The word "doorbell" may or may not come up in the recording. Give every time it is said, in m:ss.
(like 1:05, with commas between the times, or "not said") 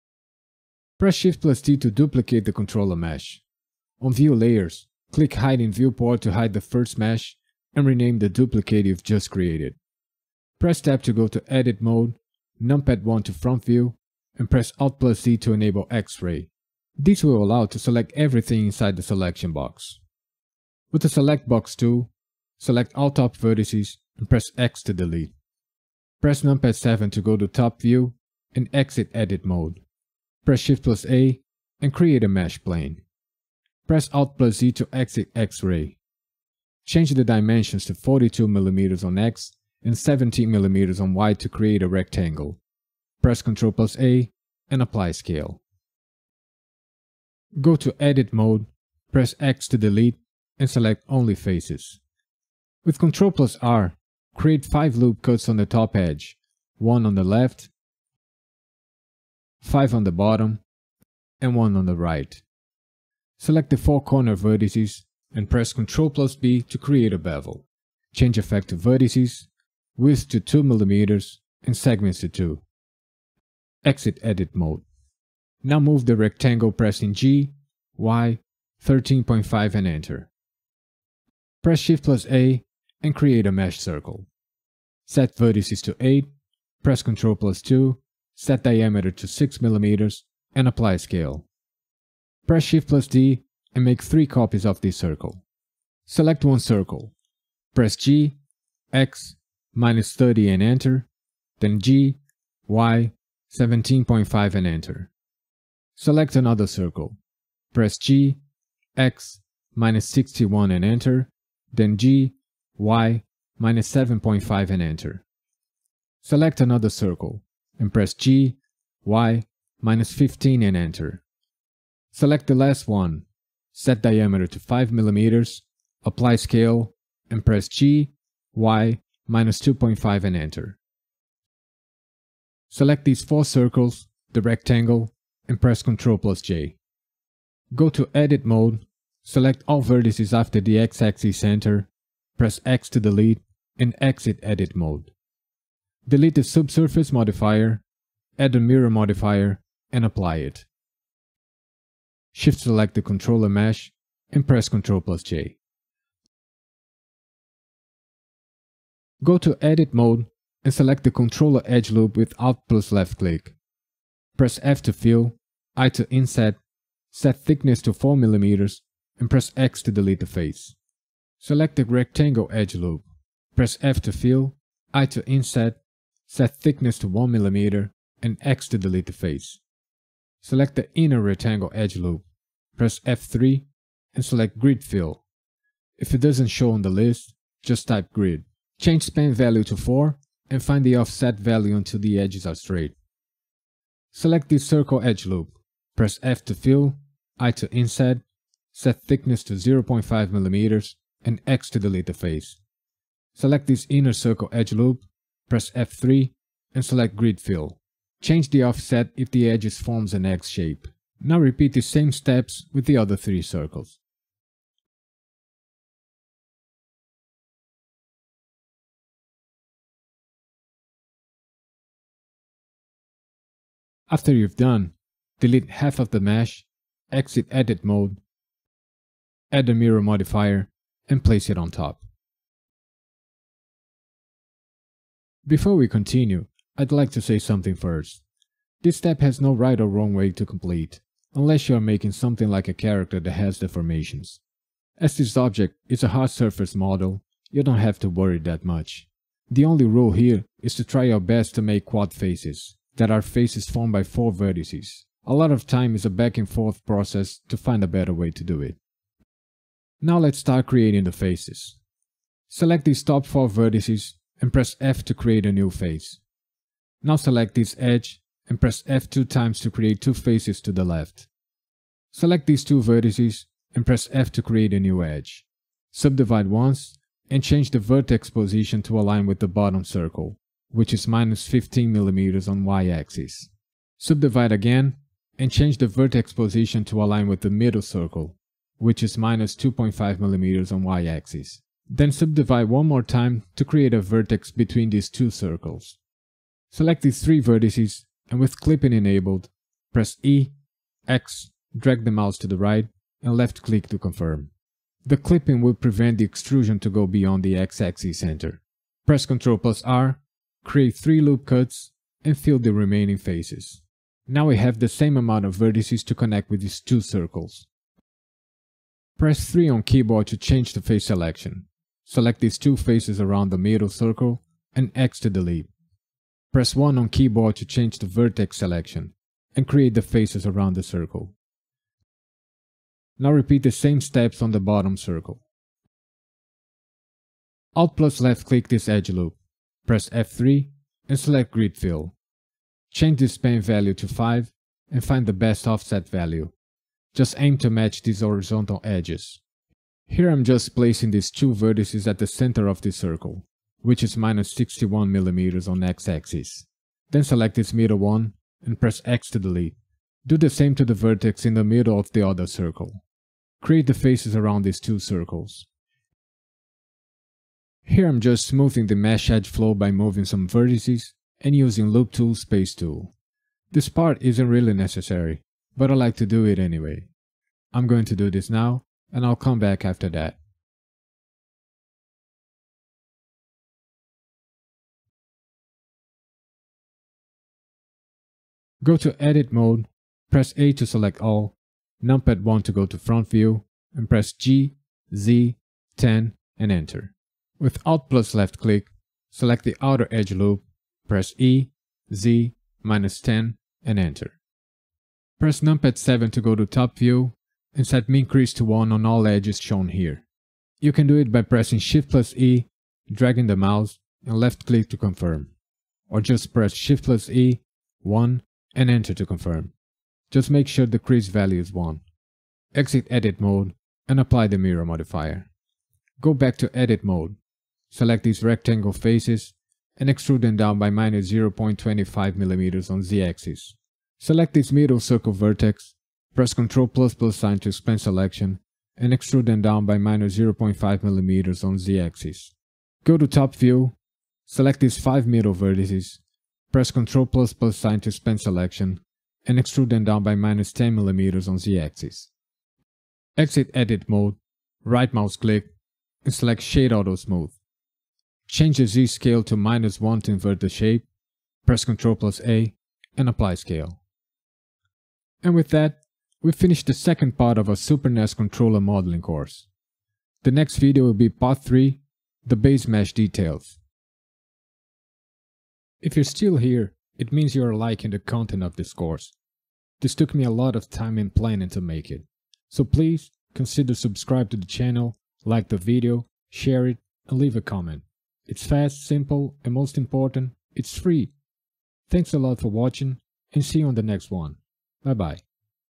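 not said.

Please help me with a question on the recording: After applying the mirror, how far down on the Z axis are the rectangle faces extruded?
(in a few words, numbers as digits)
-0.25 mm.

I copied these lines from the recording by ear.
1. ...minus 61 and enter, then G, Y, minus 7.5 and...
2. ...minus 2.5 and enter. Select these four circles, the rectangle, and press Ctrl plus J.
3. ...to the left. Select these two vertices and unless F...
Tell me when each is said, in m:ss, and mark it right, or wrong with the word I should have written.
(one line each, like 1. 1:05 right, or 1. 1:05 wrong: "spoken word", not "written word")
1. 1:49 right
2. 2:09 right
3. 4:30 wrong: "press", not "unless".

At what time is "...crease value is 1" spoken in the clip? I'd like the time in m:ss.
7:00.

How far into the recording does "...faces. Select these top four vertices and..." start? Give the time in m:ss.
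4:21.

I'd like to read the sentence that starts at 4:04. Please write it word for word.
As this object is a hard surface model, you don't have to worry that much.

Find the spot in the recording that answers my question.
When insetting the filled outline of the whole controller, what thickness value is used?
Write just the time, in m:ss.
2:47.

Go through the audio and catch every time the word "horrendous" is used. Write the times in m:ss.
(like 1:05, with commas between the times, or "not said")
not said.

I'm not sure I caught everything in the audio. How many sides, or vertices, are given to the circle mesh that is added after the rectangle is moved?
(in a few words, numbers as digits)
8.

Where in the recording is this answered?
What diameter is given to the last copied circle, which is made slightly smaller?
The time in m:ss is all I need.
2:04.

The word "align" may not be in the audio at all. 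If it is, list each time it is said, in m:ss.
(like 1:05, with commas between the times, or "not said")
4:38, 4:47.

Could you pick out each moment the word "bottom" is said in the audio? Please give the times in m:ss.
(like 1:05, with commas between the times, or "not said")
1:00, 4:39, 5:34.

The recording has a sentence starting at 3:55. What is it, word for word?
Before we continue, I'd like to say something first.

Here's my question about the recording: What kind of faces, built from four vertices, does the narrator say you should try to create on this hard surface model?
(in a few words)
quad faces.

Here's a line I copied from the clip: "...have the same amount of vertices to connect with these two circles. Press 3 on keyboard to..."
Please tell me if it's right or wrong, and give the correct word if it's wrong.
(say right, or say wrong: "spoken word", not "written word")
right.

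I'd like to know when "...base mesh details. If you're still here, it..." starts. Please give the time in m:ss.
7:52.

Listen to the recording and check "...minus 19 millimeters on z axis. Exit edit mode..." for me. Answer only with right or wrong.
wrong.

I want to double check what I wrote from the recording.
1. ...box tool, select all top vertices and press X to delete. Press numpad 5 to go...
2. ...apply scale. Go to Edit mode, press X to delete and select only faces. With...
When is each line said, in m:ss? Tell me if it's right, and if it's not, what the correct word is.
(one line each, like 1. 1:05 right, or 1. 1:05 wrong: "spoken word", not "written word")
1. 0:21 wrong: "7", not "5"
2. 0:44 right.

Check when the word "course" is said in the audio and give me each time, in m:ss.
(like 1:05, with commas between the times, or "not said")
7:49, 7:58.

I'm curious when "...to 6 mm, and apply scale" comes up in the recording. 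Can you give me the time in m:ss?
1:29.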